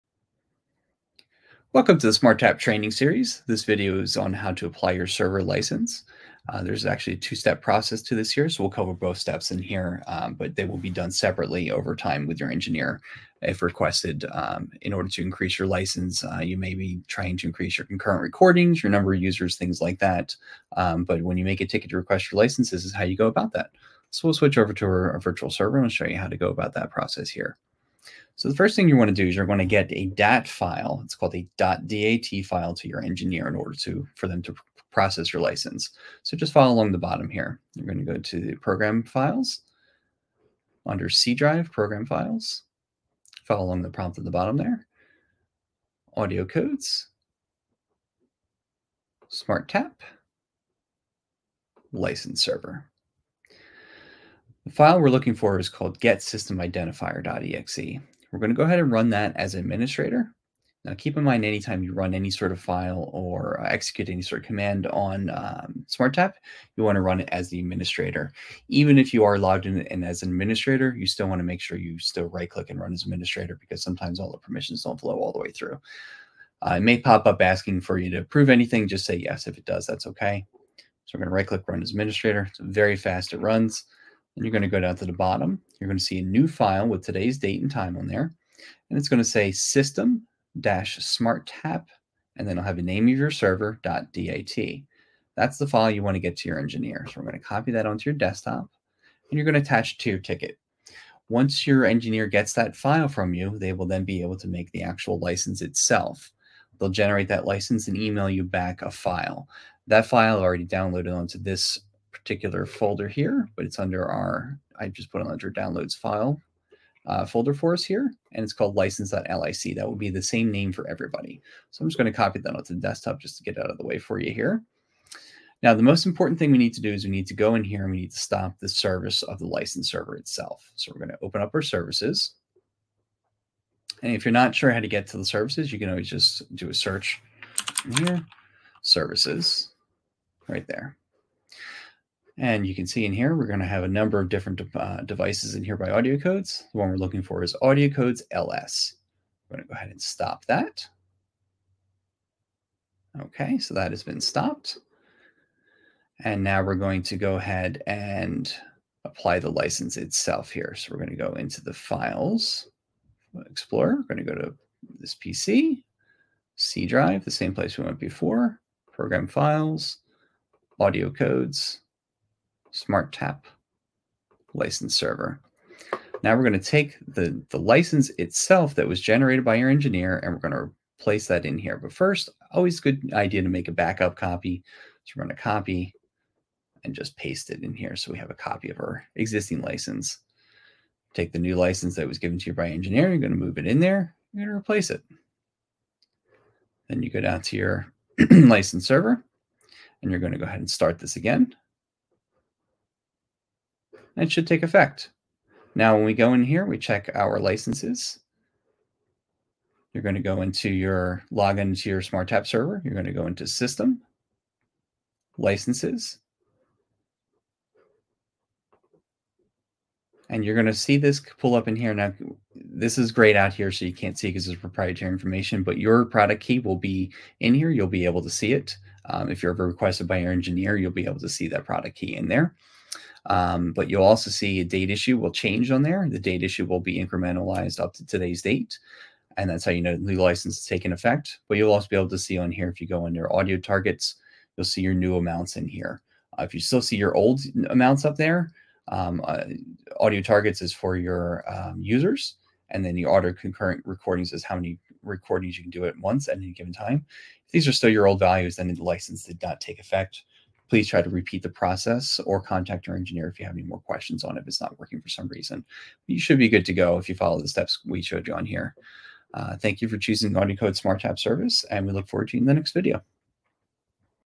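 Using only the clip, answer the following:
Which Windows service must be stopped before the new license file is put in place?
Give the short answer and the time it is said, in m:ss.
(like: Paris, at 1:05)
AudioCodes LS, at 2:27.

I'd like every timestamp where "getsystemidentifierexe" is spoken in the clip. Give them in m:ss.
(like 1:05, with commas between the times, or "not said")
0:55.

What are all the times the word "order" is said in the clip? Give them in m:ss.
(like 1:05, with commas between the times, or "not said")
0:14, 0:33.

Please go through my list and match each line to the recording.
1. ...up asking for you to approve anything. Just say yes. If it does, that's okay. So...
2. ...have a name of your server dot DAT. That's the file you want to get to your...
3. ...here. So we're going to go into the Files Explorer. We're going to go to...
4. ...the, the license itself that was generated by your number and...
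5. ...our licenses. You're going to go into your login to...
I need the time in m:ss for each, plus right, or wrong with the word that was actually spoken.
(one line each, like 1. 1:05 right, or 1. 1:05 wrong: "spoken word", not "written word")
1. 1:17 right
2. 1:32 right
3. 2:40 right
4. 2:57 wrong: "engineer", not "number"
5. 3:27 right.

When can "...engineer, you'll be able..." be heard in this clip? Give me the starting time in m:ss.
3:50.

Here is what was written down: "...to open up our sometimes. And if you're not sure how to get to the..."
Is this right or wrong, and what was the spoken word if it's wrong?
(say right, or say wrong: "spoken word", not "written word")
wrong: "services", not "sometimes".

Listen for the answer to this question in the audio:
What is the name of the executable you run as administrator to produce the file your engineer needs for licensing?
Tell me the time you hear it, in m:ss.
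0:55.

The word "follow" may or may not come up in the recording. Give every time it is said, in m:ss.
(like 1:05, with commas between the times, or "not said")
0:36, 0:43, 4:27.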